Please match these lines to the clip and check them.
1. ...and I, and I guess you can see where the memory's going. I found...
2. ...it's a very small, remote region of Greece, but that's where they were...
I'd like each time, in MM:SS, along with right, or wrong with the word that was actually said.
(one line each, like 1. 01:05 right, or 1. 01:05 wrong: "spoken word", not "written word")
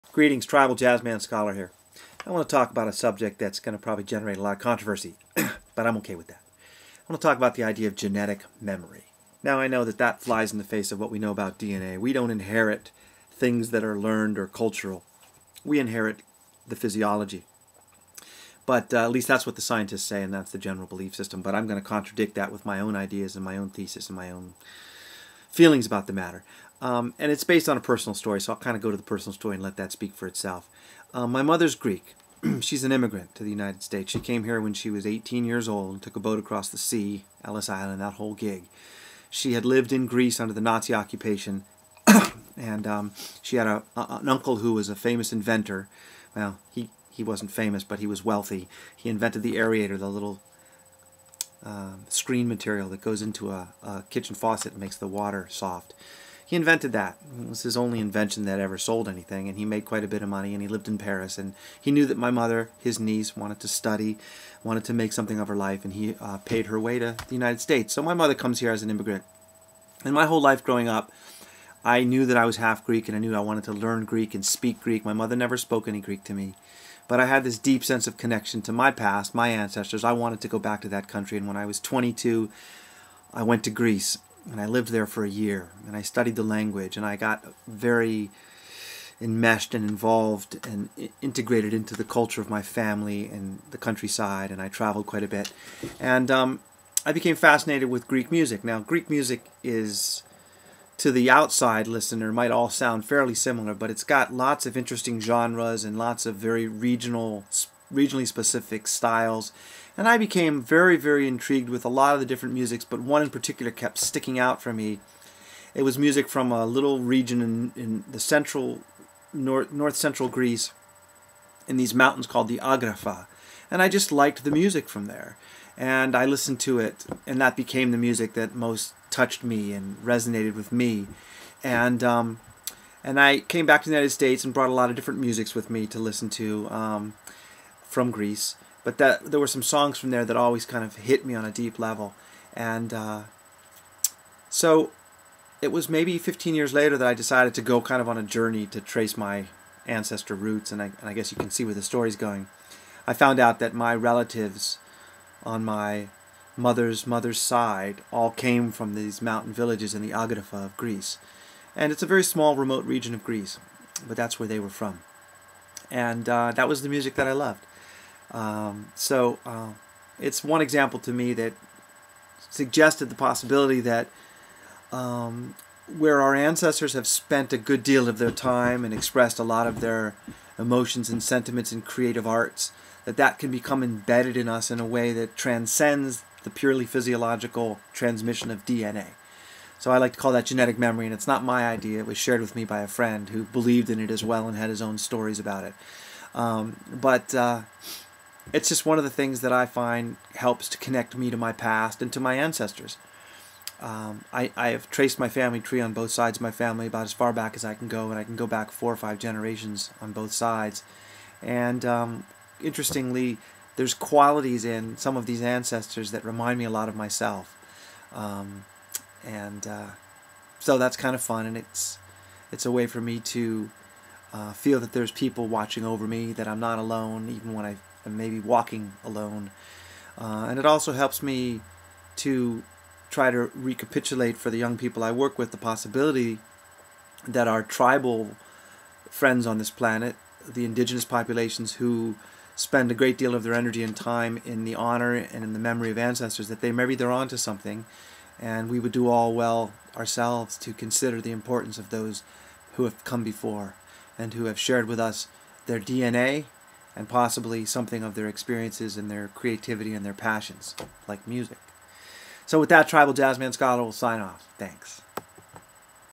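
1. 02:30 wrong: "story", not "memory"
2. 02:41 right.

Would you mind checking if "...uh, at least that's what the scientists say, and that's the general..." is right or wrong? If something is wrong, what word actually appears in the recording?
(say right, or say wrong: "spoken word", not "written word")
right.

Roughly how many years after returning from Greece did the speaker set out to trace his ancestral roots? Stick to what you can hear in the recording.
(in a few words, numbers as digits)
15 years.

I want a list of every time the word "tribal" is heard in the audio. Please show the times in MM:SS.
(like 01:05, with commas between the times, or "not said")
00:00, 03:57, 04:22.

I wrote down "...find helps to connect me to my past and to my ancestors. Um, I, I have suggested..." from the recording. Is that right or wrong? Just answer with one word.
wrong.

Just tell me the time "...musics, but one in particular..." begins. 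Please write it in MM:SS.
01:52.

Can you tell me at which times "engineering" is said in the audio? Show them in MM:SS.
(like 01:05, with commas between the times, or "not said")
not said.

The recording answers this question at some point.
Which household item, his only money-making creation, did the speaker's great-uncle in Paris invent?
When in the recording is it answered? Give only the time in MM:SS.
00:49.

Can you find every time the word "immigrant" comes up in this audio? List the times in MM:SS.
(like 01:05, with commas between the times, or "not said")
00:32, 01:08.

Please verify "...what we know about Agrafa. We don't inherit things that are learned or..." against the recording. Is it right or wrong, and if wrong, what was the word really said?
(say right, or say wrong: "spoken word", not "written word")
wrong: "DNA", not "Agrafa".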